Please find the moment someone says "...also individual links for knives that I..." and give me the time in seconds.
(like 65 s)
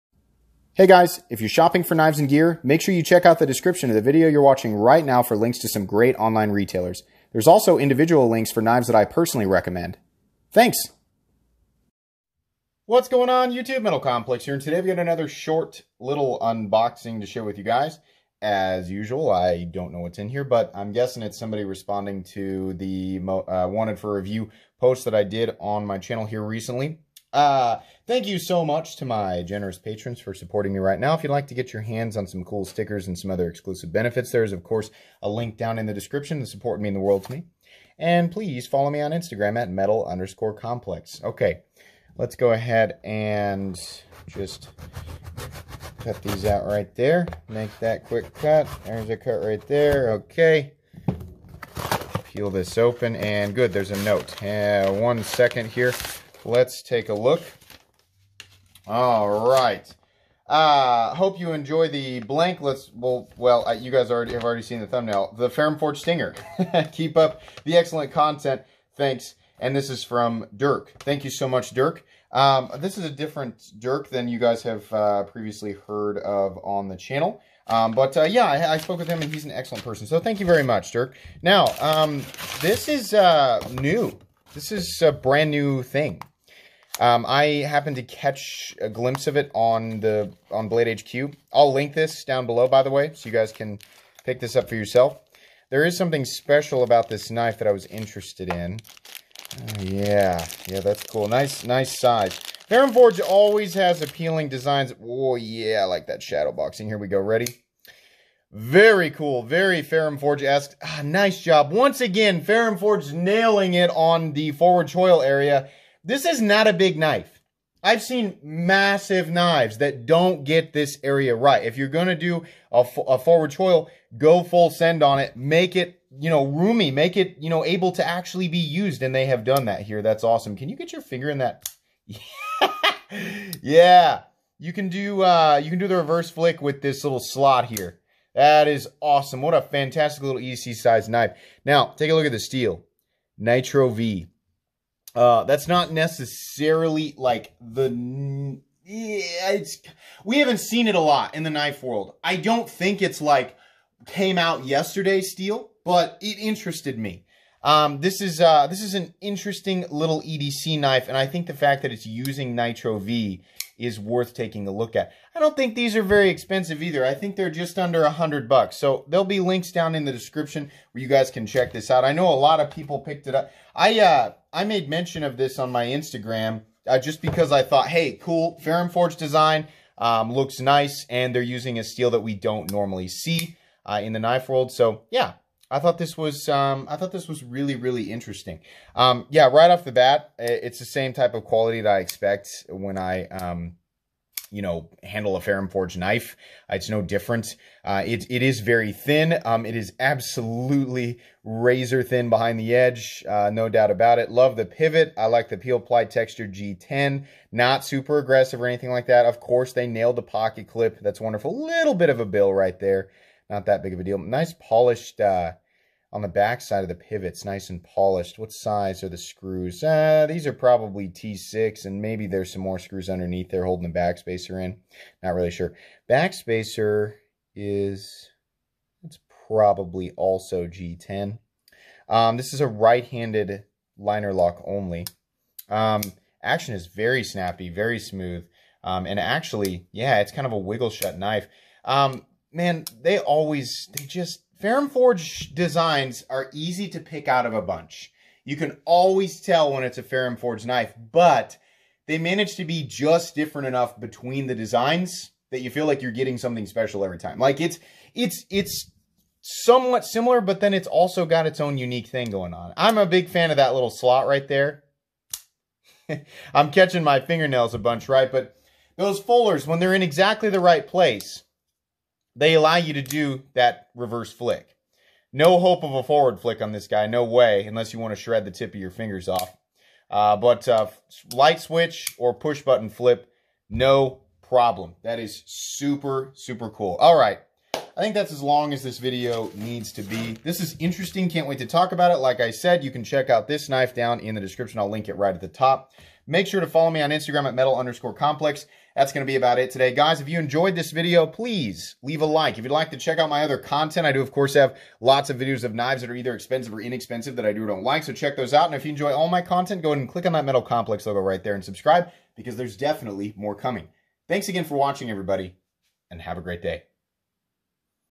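7 s.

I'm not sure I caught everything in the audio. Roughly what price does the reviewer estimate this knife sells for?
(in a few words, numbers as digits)
Just under 100 dollars.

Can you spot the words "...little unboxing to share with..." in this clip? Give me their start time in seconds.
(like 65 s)
15 s.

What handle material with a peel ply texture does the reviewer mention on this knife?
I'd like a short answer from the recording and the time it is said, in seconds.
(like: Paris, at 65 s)
G10, at 205 s.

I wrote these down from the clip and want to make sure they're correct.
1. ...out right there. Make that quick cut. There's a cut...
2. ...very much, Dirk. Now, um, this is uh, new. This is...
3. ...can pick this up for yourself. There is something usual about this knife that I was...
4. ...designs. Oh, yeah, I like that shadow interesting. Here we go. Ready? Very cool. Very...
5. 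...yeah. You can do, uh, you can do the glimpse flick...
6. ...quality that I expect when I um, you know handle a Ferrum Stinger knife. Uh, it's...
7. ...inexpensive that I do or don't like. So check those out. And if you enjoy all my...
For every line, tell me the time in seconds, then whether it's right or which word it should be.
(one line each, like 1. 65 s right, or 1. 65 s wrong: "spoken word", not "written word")
1. 46 s right
2. 80 s right
3. 93 s wrong: "special", not "usual"
4. 104 s wrong: "boxing", not "interesting"
5. 133 s wrong: "reverse", not "glimpse"
6. 191 s wrong: "Forge", not "Stinger"
7. 306 s right.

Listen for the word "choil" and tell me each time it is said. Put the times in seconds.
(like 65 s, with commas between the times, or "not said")
114 s, 123 s.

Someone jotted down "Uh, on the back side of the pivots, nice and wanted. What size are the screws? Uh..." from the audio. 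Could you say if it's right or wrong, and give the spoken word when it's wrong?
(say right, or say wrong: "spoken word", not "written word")
wrong: "polished", not "wanted".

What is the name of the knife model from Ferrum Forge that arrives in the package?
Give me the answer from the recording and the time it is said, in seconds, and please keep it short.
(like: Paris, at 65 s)
Stinger, at 65 s.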